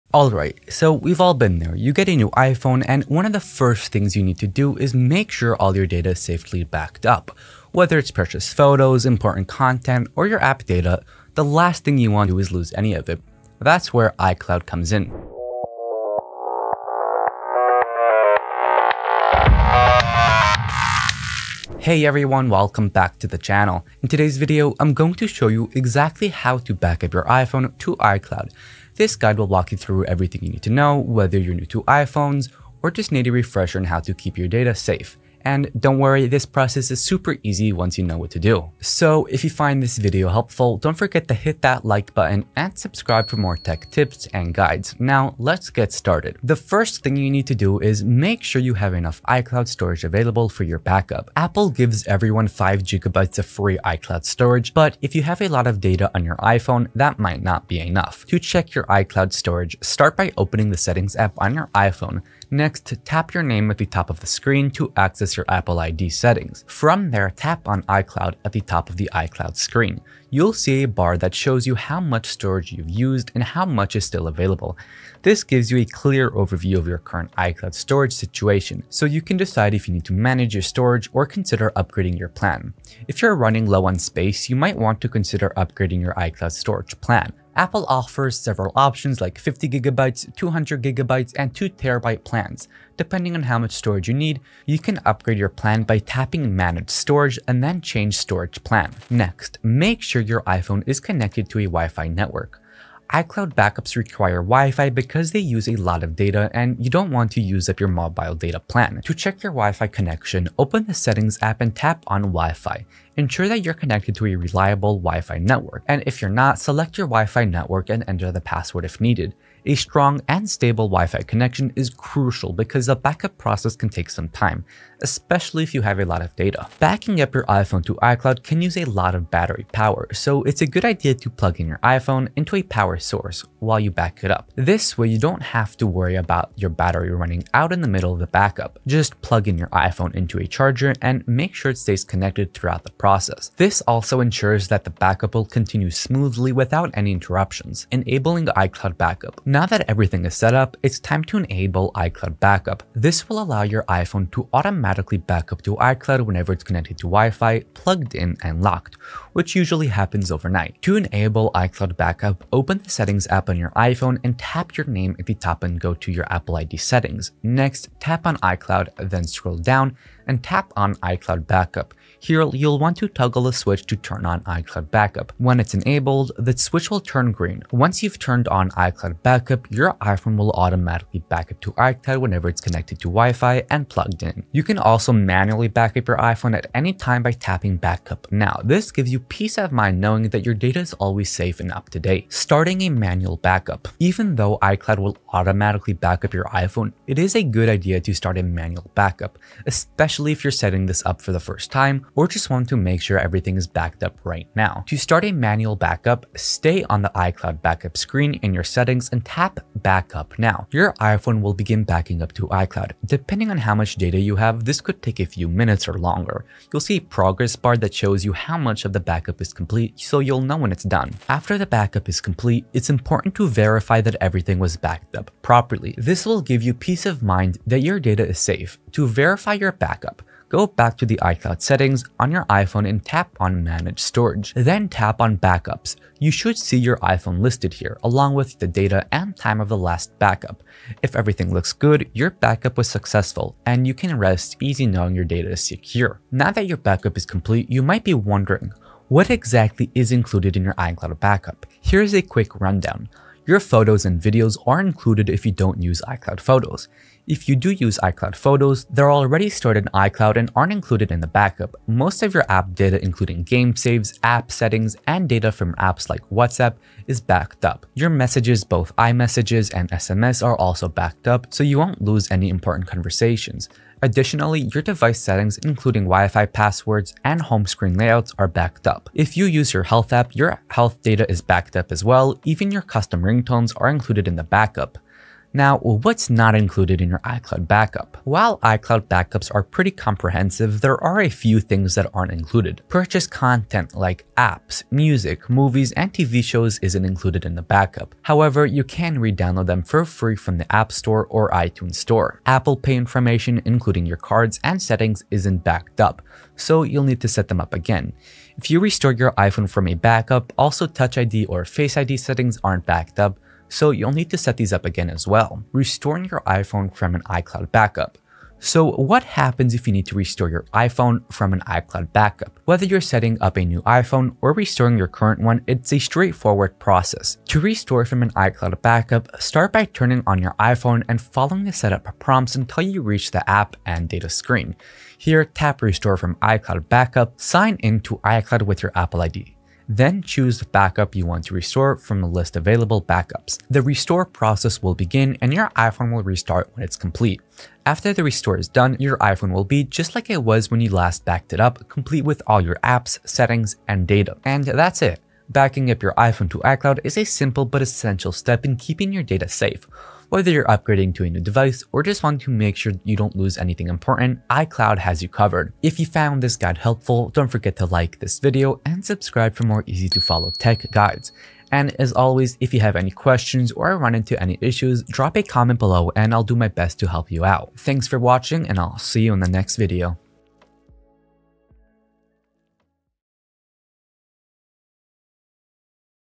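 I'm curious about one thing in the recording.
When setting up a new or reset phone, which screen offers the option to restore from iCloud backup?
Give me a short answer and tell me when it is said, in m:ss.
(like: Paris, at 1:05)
app and data screen, at 5:33.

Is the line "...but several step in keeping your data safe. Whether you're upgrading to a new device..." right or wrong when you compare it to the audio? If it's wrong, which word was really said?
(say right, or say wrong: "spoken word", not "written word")
wrong: "essential", not "several".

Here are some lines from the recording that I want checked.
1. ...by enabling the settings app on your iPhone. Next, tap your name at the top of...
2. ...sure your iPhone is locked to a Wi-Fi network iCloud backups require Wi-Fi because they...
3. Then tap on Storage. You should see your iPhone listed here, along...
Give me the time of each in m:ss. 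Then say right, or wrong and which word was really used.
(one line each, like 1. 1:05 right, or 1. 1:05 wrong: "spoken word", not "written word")
1. 1:00 wrong: "opening", not "enabling"
2. 1:40 wrong: "connected", not "locked"
3. 3:54 wrong: "Backups", not "Storage".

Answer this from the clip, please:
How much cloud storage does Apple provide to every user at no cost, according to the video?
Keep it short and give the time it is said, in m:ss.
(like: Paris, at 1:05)
5 gigabytes, at 0:52.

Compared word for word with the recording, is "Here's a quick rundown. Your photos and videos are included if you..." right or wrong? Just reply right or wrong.
right.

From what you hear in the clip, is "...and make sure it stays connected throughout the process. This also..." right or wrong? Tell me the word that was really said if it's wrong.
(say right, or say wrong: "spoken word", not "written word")
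right.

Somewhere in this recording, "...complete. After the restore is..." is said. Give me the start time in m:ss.
5:46.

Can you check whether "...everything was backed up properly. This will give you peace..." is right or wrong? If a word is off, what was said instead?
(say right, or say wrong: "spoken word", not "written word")
right.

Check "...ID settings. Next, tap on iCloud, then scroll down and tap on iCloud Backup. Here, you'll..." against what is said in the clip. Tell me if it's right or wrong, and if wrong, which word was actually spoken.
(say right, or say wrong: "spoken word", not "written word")
right.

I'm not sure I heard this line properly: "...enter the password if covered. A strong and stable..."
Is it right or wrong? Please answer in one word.
wrong.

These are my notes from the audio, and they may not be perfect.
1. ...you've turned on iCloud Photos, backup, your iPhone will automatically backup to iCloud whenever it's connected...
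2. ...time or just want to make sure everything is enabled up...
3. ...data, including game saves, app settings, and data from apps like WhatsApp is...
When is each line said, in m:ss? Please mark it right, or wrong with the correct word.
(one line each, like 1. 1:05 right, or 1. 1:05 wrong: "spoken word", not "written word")
1. 2:58 wrong: "Backup", not "Photos"
2. 3:21 wrong: "backed", not "enabled"
3. 4:22 right.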